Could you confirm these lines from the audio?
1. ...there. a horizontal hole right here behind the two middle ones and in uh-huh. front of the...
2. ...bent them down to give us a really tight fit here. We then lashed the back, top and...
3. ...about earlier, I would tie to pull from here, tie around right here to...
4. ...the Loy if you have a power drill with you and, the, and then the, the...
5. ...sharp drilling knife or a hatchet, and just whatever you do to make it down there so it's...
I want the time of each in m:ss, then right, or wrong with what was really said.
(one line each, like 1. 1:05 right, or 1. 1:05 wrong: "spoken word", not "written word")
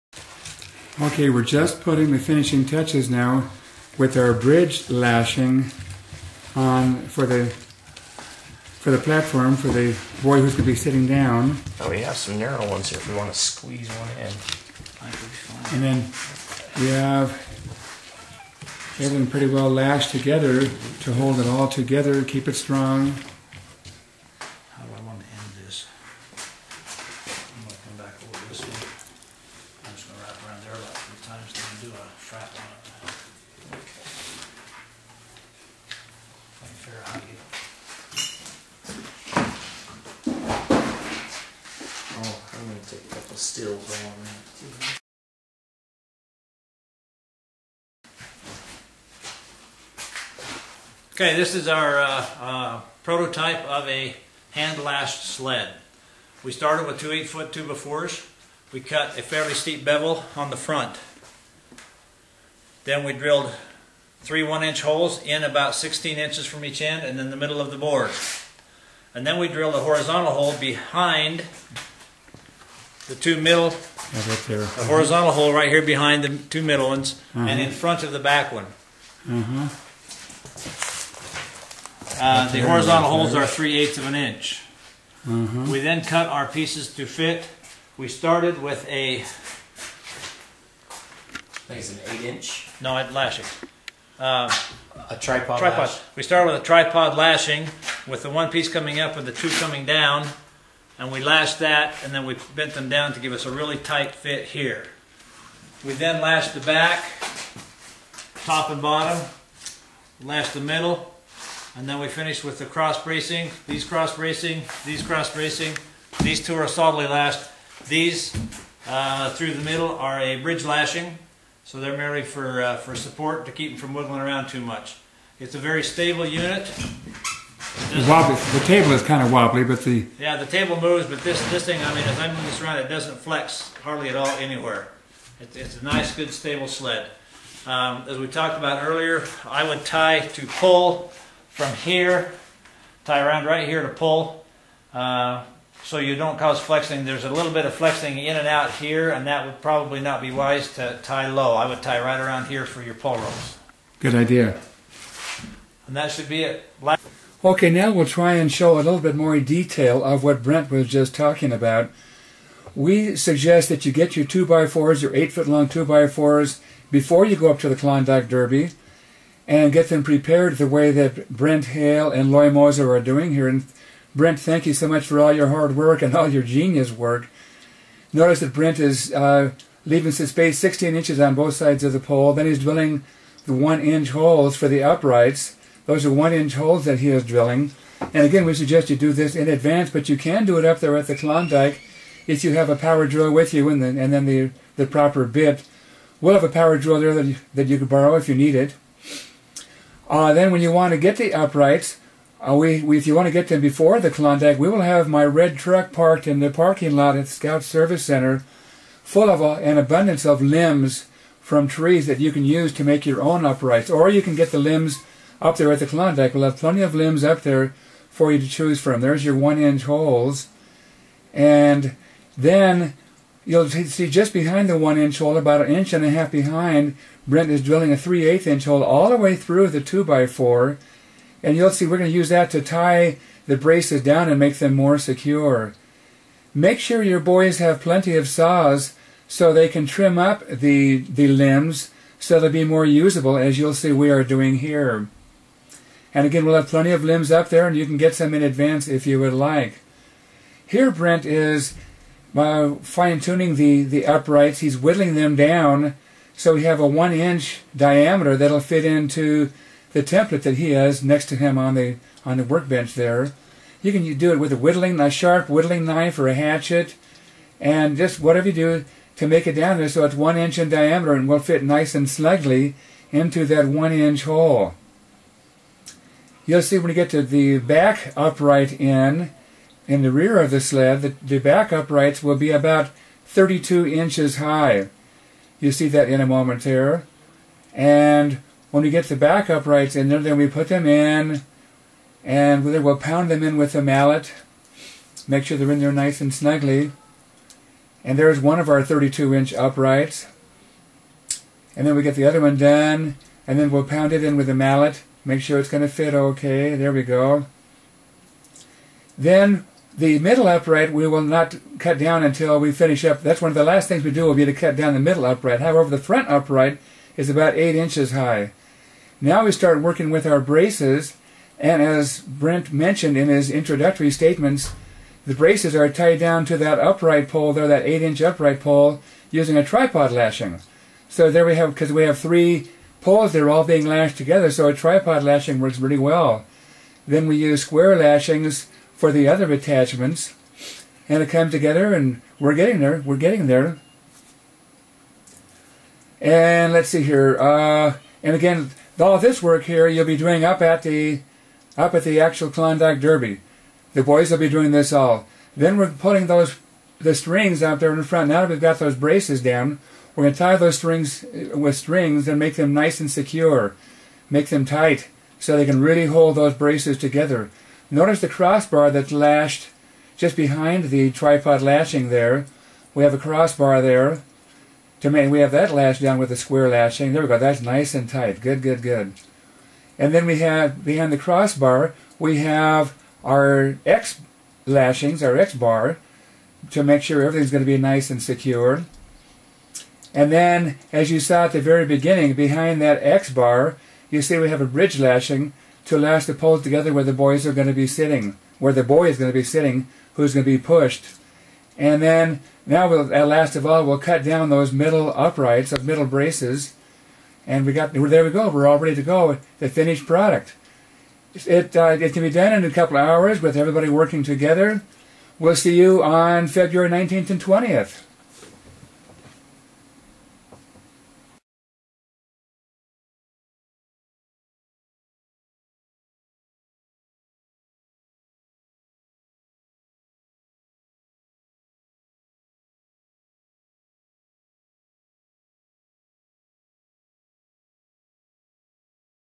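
1. 1:14 right
2. 1:42 right
3. 2:18 right
4. 3:11 wrong: "Klondike", not "Loy"
5. 4:25 wrong: "whittling", not "drilling".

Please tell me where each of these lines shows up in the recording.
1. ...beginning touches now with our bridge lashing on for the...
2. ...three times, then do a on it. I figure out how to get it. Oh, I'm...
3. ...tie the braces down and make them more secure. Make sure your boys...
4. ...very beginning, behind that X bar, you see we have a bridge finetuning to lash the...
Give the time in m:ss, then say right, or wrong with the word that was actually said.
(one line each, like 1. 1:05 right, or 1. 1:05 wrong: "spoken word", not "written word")
1. 0:02 wrong: "finishing", not "beginning"
2. 0:31 right
3. 3:52 right
4. 6:31 wrong: "lashing", not "finetuning".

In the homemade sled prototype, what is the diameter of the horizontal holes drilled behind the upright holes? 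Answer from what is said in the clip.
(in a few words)
3/8 inch.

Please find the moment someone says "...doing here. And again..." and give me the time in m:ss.
4:04.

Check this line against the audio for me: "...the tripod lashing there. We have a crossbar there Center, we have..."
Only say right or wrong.
wrong.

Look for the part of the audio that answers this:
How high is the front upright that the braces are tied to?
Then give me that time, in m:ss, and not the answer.
5:17.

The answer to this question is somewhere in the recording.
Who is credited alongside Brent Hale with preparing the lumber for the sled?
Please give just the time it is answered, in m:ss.
2:52.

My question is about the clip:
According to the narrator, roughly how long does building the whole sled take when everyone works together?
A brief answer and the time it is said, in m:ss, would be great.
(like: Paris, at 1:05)
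a couple of hours, at 6:52.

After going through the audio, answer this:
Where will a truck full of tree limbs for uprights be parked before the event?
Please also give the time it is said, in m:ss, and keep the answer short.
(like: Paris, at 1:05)
Scout Service Center, at 3:27.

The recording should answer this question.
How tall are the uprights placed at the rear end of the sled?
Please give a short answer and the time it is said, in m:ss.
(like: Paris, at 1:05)
32 inches, at 4:43.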